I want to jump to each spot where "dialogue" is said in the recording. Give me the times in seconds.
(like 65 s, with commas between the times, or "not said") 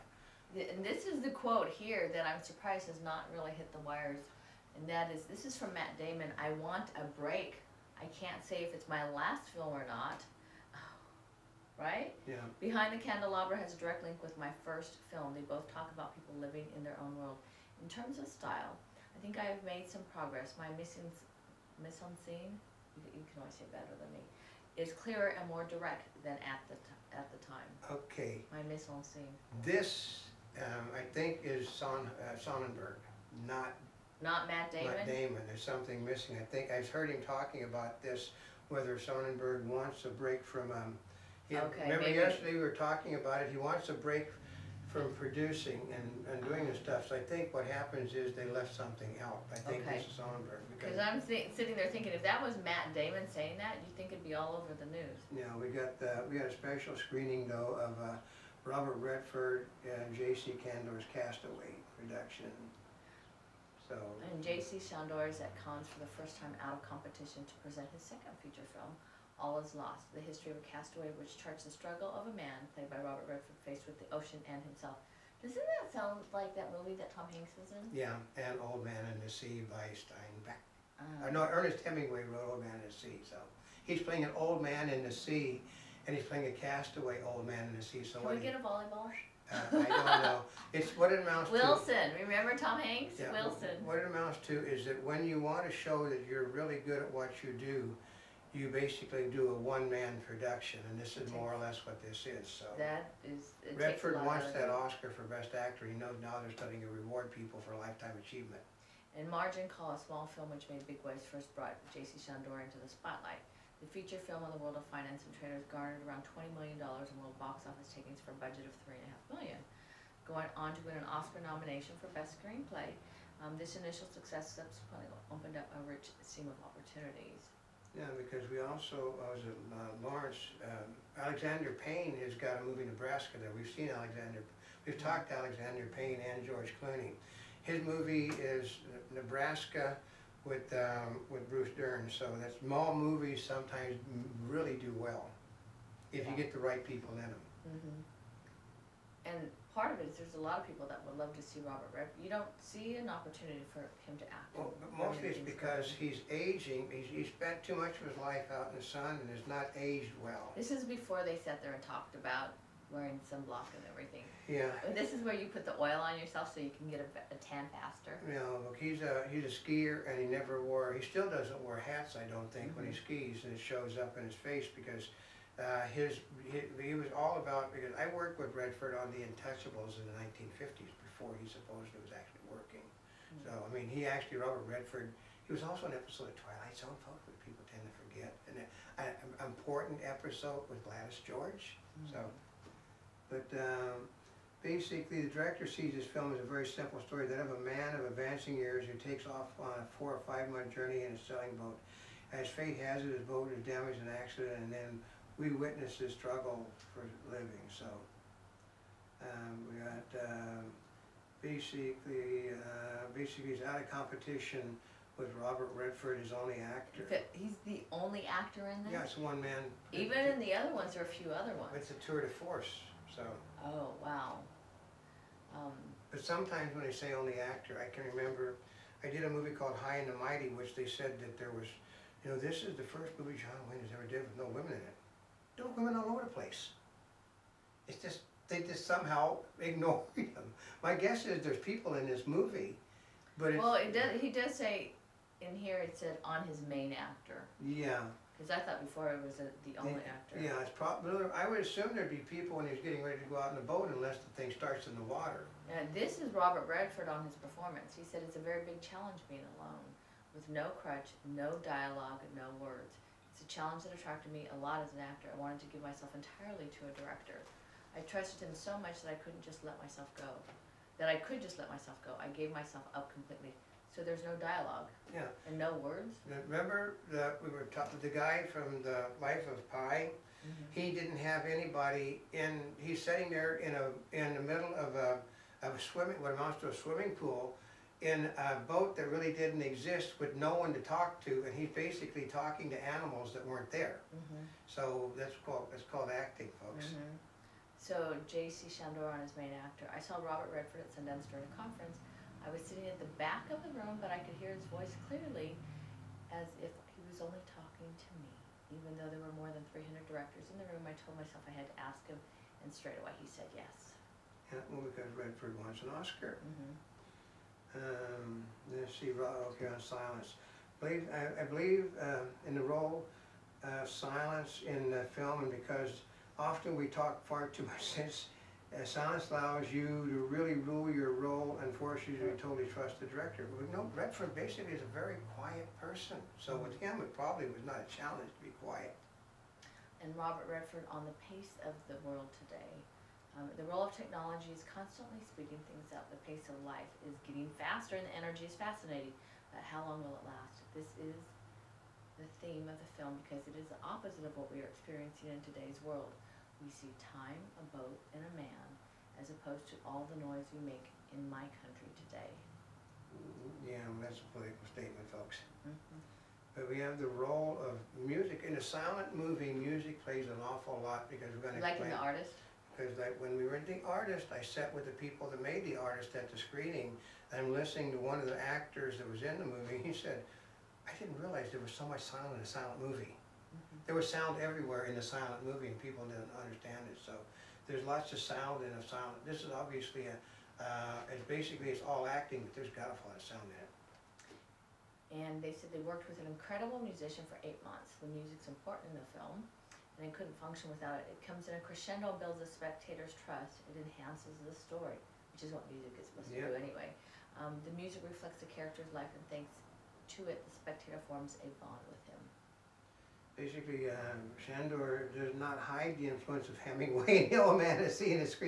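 261 s, 274 s.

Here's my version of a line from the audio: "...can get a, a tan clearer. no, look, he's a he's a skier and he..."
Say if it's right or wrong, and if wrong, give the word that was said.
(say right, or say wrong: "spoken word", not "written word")
wrong: "faster", not "clearer".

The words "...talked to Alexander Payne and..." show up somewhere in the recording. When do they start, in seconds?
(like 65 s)
134 s.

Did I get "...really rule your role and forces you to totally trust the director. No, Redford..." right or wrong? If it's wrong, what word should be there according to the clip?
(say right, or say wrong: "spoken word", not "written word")
right.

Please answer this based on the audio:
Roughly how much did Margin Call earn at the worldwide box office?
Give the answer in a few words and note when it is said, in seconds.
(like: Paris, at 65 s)
$20 million, at 116 s.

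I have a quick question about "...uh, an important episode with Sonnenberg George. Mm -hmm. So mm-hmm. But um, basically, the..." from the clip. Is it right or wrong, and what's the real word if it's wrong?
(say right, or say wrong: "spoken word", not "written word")
wrong: "Gladys", not "Sonnenberg".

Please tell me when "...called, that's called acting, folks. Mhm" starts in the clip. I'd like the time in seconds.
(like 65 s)
295 s.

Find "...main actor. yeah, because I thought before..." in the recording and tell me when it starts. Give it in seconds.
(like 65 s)
246 s.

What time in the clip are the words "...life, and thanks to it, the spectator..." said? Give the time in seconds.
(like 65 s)
408 s.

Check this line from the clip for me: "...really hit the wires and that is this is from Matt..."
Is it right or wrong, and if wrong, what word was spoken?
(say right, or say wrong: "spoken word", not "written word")
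right.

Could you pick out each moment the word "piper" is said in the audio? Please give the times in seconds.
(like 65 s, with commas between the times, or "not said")
not said.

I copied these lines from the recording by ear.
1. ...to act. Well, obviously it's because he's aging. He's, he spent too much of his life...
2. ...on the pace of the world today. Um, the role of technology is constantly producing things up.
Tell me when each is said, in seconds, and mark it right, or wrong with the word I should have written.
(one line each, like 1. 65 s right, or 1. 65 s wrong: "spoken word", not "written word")
1. 154 s wrong: "mostly", not "obviously"
2. 340 s wrong: "speeding", not "producing".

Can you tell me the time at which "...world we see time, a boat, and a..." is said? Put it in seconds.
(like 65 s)
355 s.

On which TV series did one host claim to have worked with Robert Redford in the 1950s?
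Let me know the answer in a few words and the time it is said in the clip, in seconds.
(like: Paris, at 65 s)
The Untouchables, at 179 s.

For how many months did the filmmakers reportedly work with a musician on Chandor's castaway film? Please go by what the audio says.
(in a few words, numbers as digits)
8.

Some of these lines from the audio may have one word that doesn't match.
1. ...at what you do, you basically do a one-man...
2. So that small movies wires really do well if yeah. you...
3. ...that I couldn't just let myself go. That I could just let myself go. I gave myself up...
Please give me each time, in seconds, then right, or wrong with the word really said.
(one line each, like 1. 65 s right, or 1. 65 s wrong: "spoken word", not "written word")
1. 97 s right
2. 142 s wrong: "sometimes", not "wires"
3. 269 s right.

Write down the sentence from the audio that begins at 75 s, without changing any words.
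Doesn't that sound like that movie that Tom Hanks was in?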